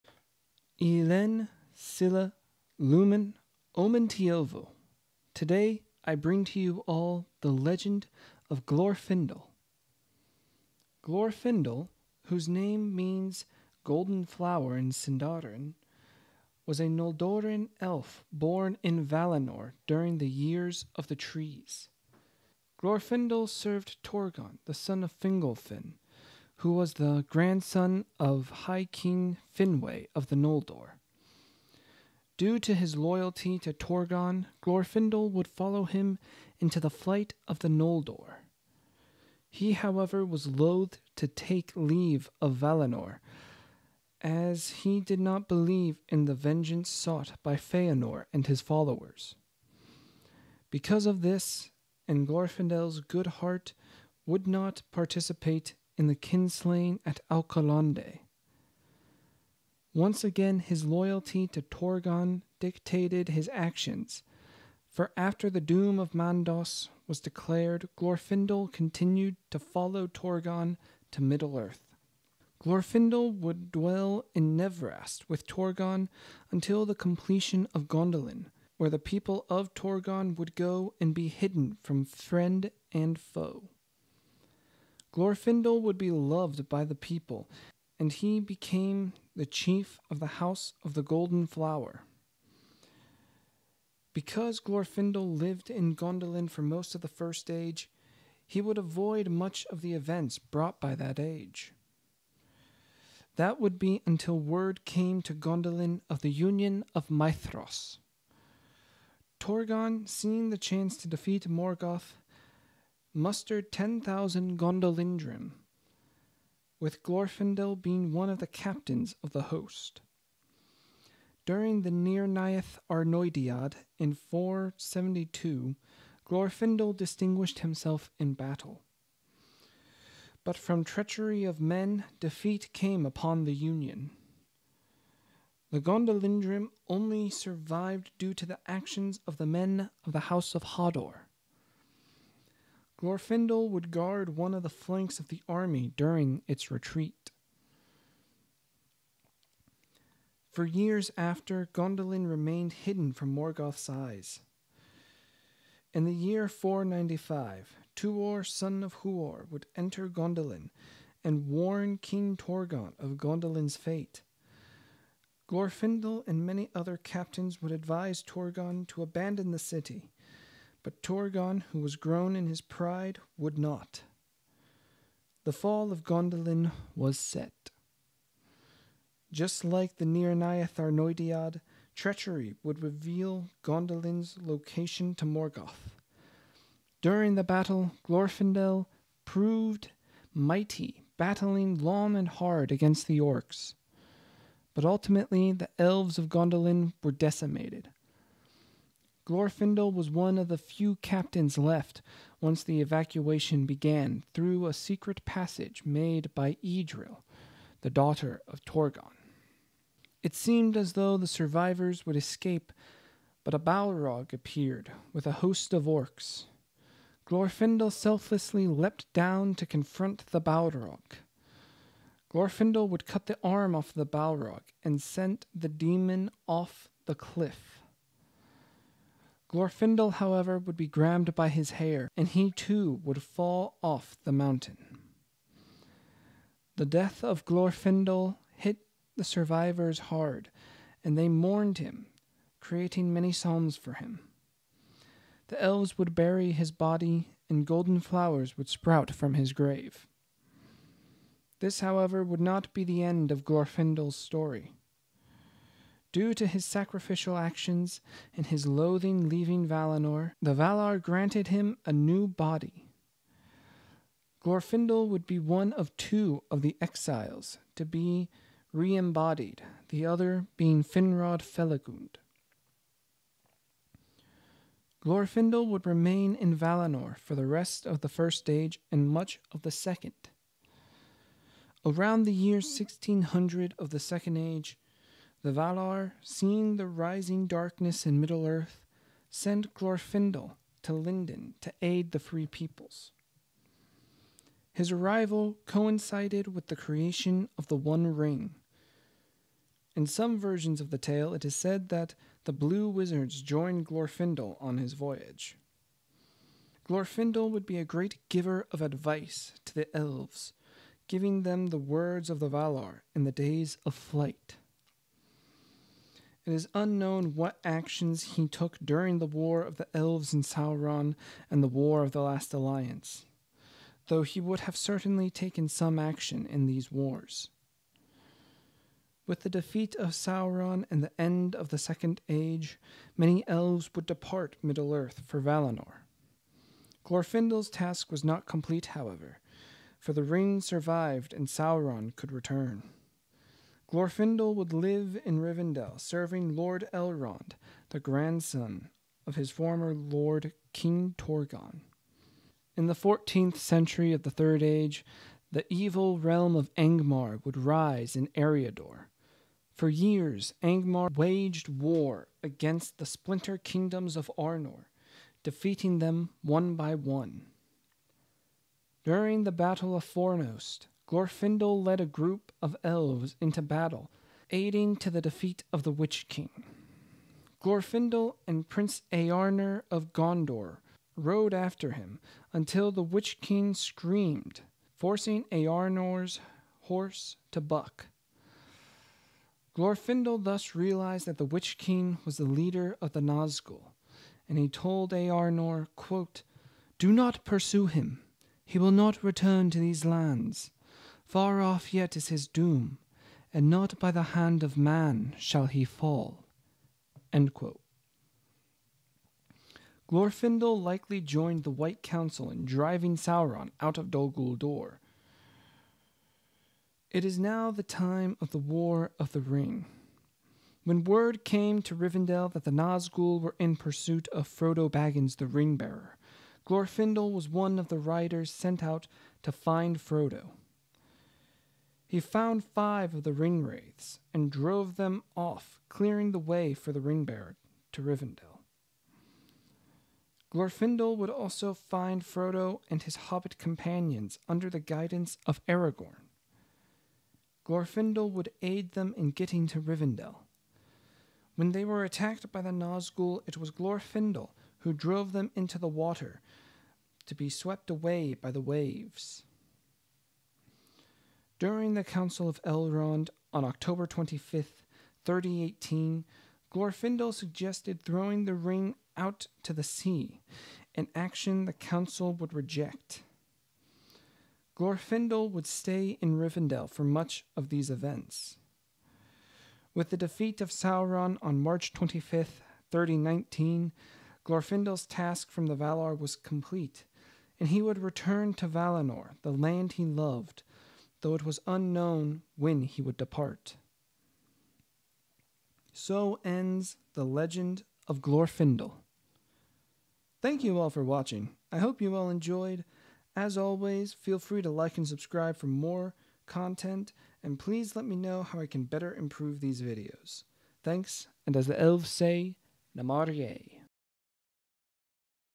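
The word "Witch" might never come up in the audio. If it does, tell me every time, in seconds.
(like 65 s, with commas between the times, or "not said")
375 s, 383 s, 391 s.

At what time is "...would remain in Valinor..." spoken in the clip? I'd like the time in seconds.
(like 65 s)
275 s.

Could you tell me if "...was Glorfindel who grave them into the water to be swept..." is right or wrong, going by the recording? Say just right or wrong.
wrong.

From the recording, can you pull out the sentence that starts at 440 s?
Glorfindel would also find Frodo and his hobbit companions under the guidance of Aragorn.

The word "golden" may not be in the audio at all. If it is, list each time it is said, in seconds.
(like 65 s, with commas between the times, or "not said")
13 s, 91 s, 247 s.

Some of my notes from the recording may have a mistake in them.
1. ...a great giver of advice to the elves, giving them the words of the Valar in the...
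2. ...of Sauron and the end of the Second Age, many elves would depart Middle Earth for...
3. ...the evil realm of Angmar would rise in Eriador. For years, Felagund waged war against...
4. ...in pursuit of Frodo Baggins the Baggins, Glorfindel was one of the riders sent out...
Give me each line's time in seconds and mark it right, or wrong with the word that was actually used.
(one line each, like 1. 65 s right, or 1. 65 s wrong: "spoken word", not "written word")
1. 307 s right
2. 329 s right
3. 355 s wrong: "Angmar", not "Felagund"
4. 423 s wrong: "Ringbearer", not "Baggins".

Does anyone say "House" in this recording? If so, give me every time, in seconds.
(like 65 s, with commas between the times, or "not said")
90 s, 140 s.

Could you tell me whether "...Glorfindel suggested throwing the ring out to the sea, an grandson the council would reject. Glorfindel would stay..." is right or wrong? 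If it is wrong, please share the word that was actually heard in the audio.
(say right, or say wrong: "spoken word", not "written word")
wrong: "action", not "grandson".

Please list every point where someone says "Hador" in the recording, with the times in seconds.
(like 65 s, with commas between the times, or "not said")
140 s.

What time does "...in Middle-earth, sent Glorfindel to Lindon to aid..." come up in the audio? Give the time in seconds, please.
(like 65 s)
288 s.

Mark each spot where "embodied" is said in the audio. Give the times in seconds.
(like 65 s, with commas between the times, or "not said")
268 s.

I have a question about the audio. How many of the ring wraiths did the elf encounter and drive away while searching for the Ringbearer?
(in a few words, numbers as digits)
5.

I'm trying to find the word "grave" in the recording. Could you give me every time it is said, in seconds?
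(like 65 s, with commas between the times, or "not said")
249 s.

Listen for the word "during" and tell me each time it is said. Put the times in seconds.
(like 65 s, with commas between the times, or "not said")
19 s, 121 s, 145 s, 187 s, 318 s, 369 s, 461 s.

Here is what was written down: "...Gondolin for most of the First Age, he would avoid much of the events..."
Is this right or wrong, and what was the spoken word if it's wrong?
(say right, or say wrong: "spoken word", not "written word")
right.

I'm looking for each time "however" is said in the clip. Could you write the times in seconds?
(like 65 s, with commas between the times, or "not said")
39 s, 230 s, 251 s, 338 s.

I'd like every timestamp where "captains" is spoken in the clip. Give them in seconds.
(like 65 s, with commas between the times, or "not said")
118 s, 166 s, 200 s.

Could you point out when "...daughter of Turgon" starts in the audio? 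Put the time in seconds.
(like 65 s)
207 s.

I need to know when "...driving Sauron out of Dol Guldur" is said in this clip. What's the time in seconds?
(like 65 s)
412 s.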